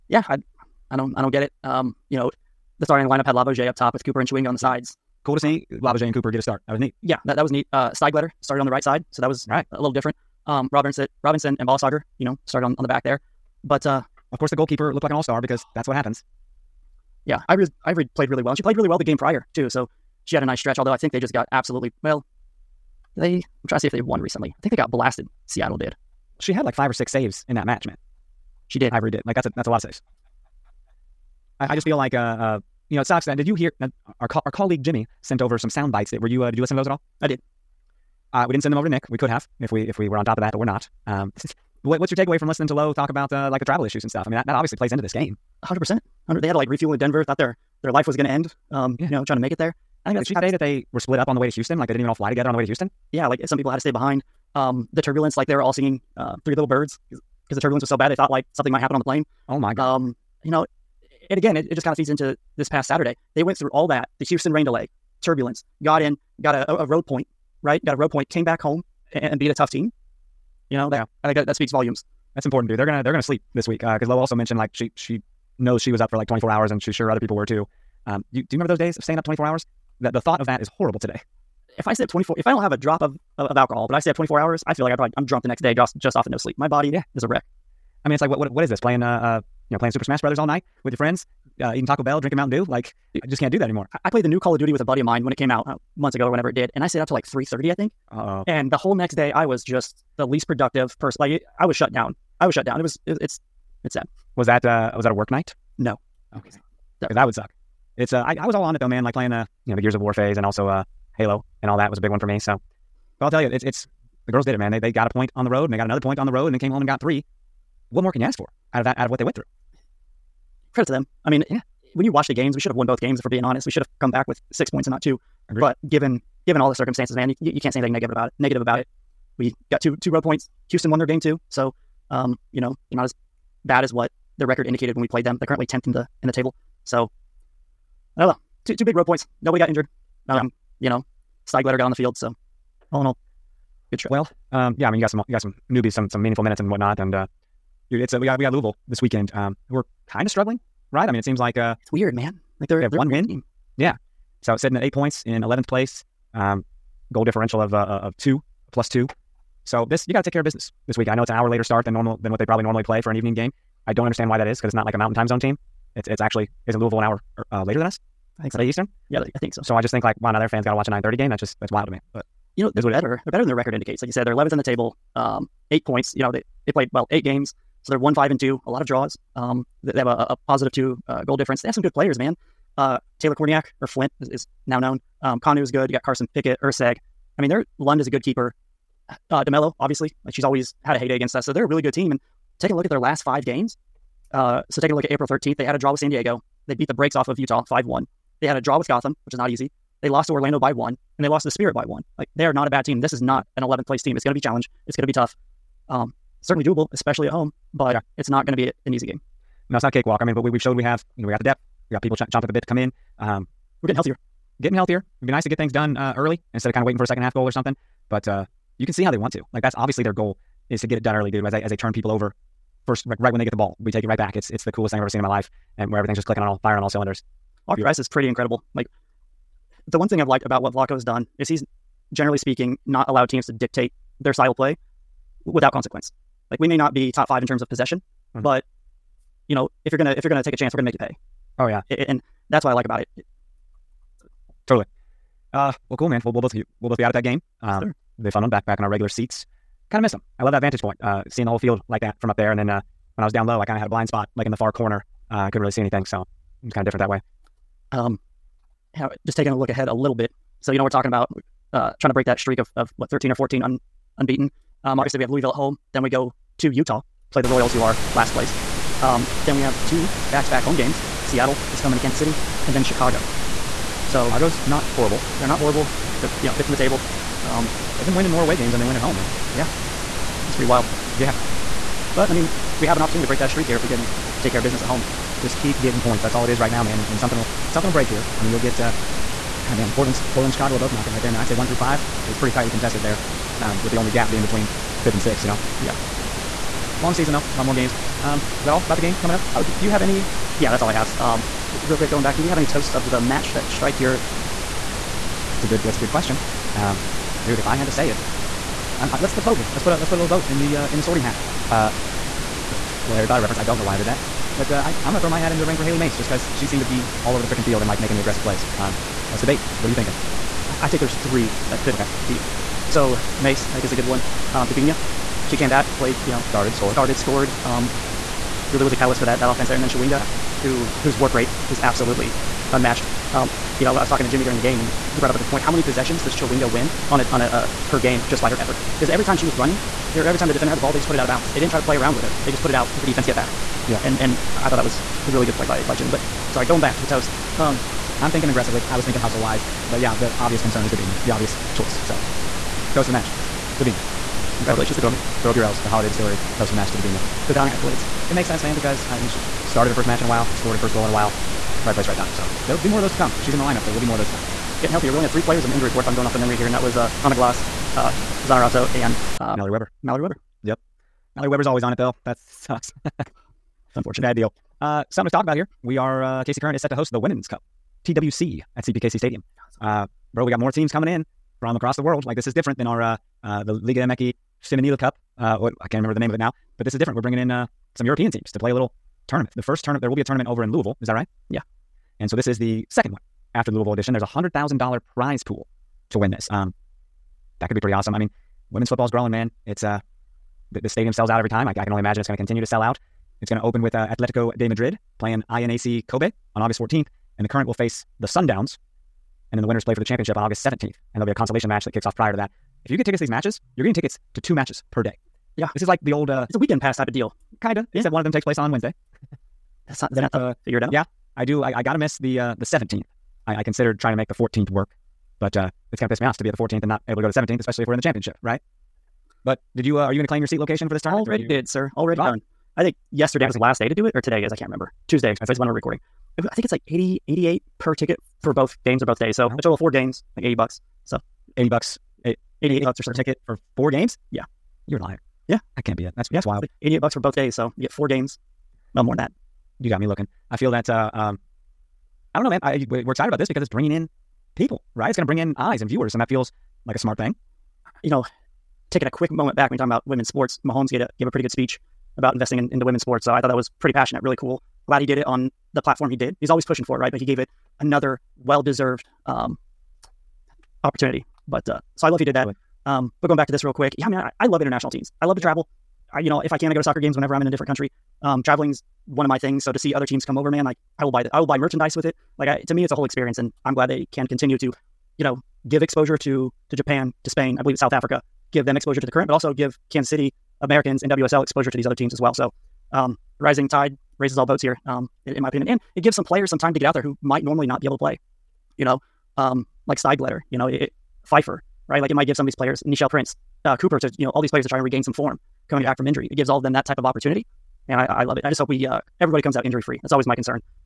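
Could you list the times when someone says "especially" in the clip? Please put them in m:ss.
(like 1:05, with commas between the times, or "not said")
3:26, 7:07.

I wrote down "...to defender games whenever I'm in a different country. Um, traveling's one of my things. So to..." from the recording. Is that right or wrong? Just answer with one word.
wrong.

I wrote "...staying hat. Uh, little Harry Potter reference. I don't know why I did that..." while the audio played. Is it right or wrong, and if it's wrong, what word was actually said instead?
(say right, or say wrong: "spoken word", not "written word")
wrong: "sorting", not "staying".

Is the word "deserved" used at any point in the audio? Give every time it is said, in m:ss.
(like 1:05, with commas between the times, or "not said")
7:48.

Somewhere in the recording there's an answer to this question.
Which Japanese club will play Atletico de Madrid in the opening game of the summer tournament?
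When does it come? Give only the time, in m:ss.
6:45.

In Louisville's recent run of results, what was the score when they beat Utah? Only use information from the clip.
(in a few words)
5-1.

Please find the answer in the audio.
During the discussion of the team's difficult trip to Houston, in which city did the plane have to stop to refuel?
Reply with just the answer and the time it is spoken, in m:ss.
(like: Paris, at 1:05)
Denver, at 0:46.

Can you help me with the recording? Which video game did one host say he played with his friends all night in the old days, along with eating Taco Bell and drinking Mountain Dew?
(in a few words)
Super Smash Brothers.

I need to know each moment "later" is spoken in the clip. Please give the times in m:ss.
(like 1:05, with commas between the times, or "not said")
2:41, 2:47.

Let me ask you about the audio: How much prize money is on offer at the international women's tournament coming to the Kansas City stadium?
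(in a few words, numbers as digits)
$100,000.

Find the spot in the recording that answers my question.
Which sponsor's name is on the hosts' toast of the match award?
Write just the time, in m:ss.
5:55.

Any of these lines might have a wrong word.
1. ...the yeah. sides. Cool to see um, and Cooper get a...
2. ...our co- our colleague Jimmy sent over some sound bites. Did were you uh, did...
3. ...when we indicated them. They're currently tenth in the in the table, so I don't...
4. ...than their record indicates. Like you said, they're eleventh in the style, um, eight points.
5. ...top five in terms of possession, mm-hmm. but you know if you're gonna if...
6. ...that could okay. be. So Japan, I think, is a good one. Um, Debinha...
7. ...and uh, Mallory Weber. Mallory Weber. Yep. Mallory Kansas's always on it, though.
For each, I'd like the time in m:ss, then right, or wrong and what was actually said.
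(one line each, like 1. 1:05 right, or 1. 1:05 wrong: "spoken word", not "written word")
1. 0:04 right
2. 0:34 right
3. 2:14 wrong: "played", not "indicated"
4. 2:53 wrong: "table", not "style"
5. 3:57 right
6. 5:21 wrong: "Mace", not "Japan"
7. 6:08 wrong: "Weber", not "Kansas".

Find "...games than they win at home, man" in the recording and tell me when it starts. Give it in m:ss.
4:38.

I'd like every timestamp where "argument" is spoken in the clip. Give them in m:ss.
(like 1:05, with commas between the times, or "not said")
not said.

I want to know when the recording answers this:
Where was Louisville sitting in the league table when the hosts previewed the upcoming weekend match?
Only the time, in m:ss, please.
2:35.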